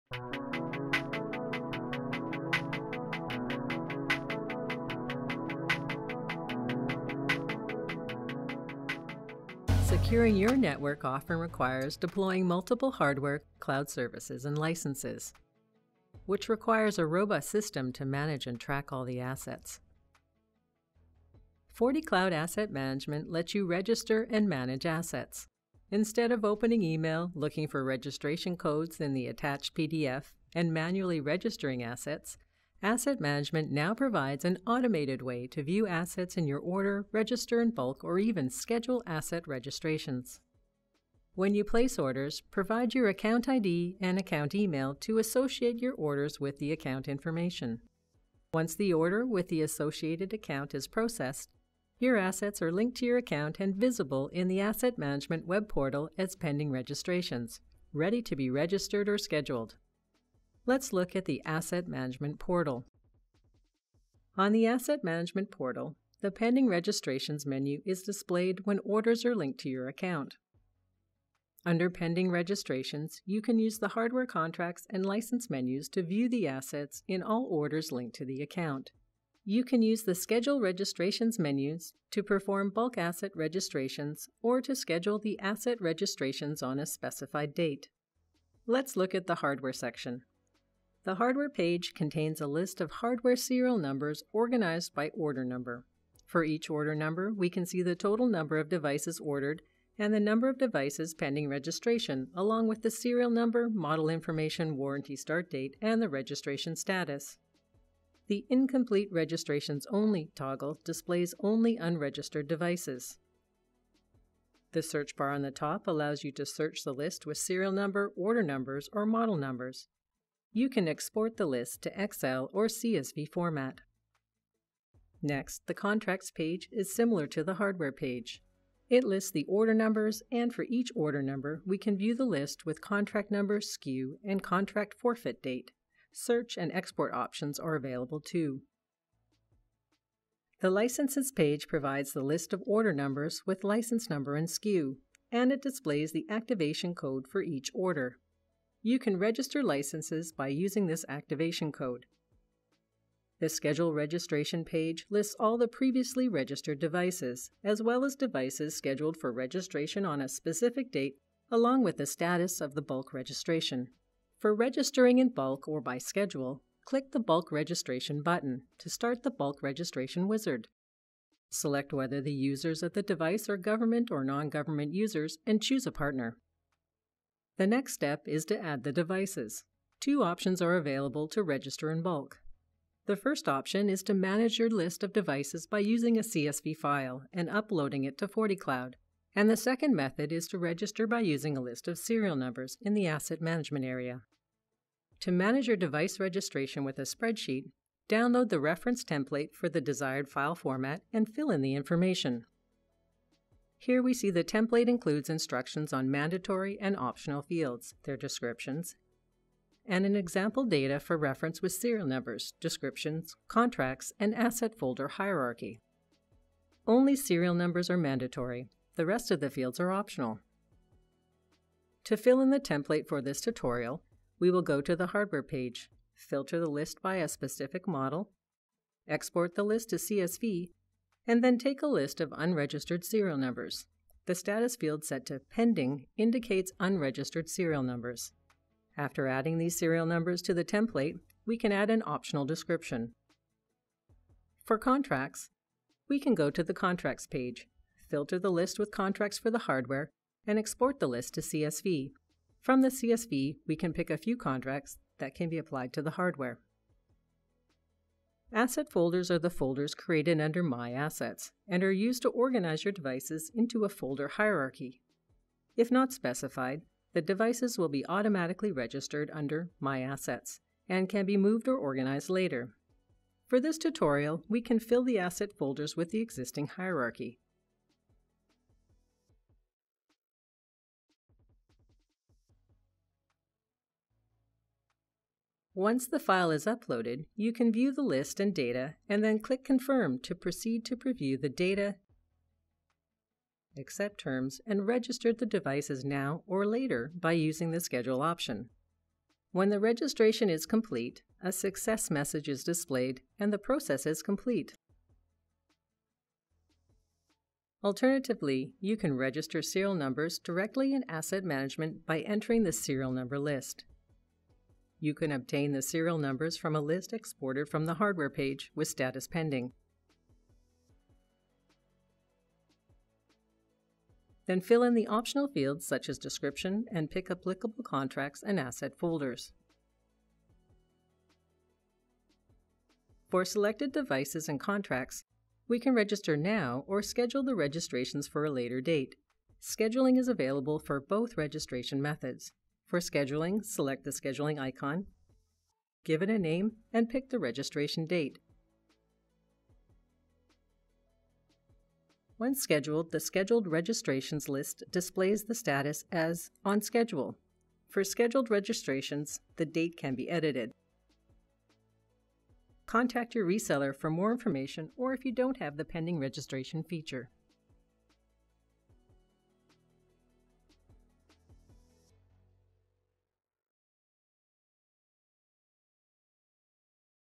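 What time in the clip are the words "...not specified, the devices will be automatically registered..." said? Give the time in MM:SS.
04:25.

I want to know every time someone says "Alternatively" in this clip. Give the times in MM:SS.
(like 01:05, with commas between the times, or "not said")
05:07.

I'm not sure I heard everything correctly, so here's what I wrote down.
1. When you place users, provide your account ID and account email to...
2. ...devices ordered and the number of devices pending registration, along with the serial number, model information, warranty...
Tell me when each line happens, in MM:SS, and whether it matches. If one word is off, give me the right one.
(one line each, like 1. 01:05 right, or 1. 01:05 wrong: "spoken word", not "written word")
1. 00:41 wrong: "orders", not "users"
2. 01:38 right.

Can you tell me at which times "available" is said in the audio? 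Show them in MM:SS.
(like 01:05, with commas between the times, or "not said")
02:17, 03:00, 05:40.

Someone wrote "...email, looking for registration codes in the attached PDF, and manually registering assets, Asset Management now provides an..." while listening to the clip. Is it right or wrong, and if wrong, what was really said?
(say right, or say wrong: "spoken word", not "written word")
right.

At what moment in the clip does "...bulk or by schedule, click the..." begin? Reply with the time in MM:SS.
02:45.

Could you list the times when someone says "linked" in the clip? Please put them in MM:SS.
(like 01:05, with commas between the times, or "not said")
00:52, 01:09, 01:17.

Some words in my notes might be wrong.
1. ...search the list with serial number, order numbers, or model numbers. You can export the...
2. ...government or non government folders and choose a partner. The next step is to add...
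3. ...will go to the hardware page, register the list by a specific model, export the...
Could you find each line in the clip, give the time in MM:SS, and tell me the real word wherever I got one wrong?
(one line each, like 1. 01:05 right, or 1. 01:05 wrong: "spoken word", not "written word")
1. 01:56 right
2. 02:53 wrong: "users", not "folders"
3. 03:44 wrong: "filter", not "register".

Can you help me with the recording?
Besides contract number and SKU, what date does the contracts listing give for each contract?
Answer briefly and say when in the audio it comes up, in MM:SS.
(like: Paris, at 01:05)
contract forfeit date, at 02:14.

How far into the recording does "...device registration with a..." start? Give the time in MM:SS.
03:15.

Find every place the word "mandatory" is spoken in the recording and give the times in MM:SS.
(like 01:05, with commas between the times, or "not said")
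03:26, 03:37.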